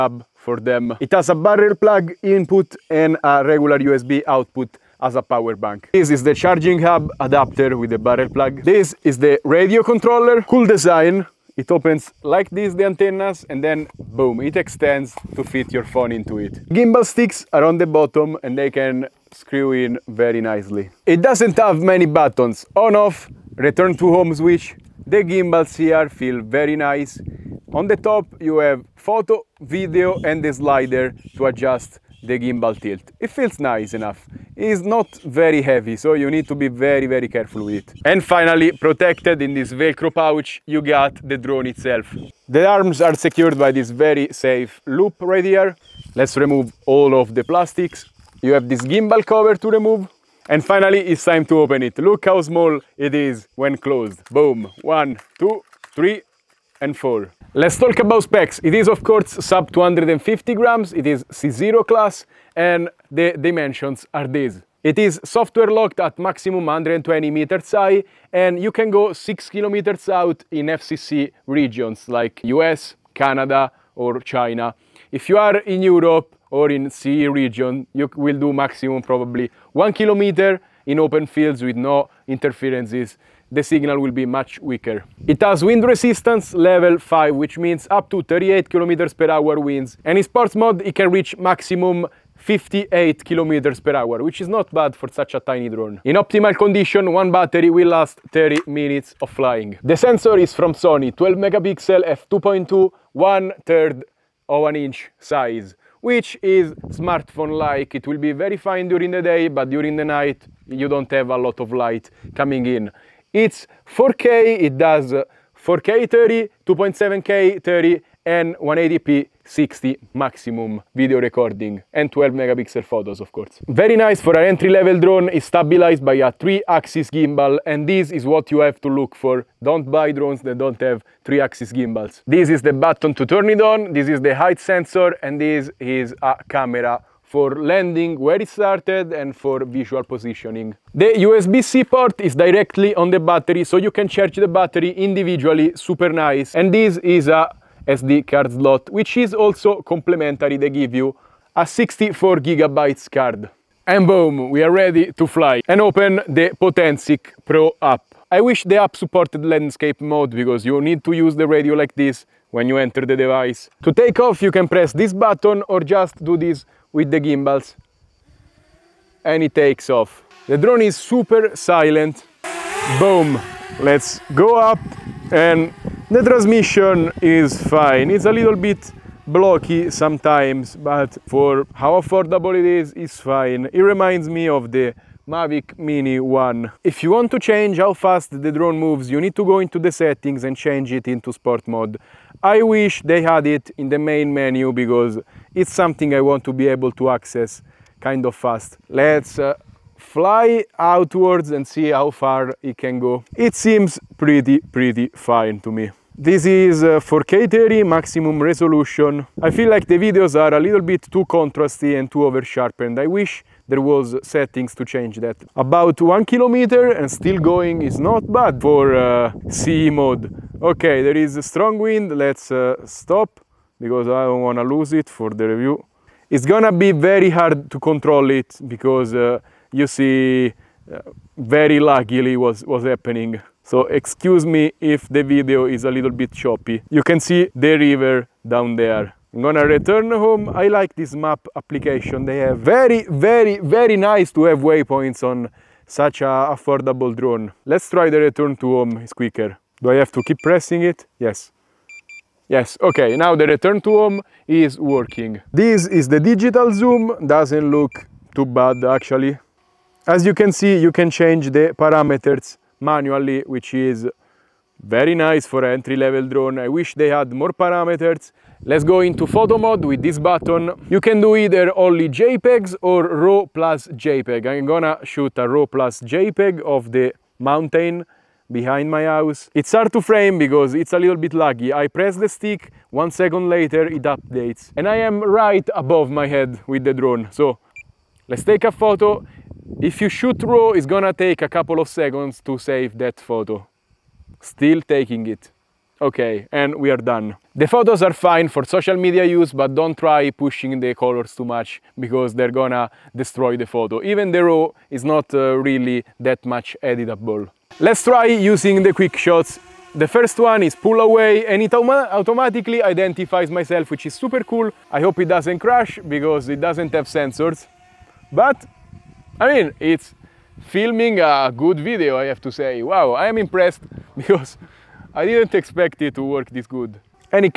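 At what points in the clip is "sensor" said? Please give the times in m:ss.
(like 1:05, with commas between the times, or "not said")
1:39, 2:14, 5:17.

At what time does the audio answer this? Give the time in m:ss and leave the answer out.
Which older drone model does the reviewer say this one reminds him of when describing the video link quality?
3:05.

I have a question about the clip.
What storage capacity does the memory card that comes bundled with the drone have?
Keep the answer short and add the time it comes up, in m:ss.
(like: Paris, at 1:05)
64 GB, at 2:31.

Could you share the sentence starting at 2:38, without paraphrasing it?
I wish the app supported landscape mode because you need to use the radio like this when you enter the device.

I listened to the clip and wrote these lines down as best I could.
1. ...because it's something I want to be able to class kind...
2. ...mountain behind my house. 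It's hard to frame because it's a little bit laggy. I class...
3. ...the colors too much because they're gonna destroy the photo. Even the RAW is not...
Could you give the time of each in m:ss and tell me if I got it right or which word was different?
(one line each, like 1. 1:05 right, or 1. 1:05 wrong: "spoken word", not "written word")
1. 3:14 wrong: "access", not "class"
2. 4:37 wrong: "press", not "class"
3. 5:00 right.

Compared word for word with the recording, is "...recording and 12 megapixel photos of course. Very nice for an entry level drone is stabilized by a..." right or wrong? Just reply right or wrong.
right.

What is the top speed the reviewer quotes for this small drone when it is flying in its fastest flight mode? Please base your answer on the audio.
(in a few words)
58 km/h.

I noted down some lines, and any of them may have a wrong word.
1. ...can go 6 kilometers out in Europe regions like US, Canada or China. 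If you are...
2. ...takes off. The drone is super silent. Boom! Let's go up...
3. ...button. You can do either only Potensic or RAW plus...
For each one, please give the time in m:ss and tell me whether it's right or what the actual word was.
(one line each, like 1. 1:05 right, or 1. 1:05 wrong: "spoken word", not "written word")
1. 1:08 wrong: "FCC", not "Europe"
2. 2:49 right
3. 4:30 wrong: "JPEGs", not "Potensic".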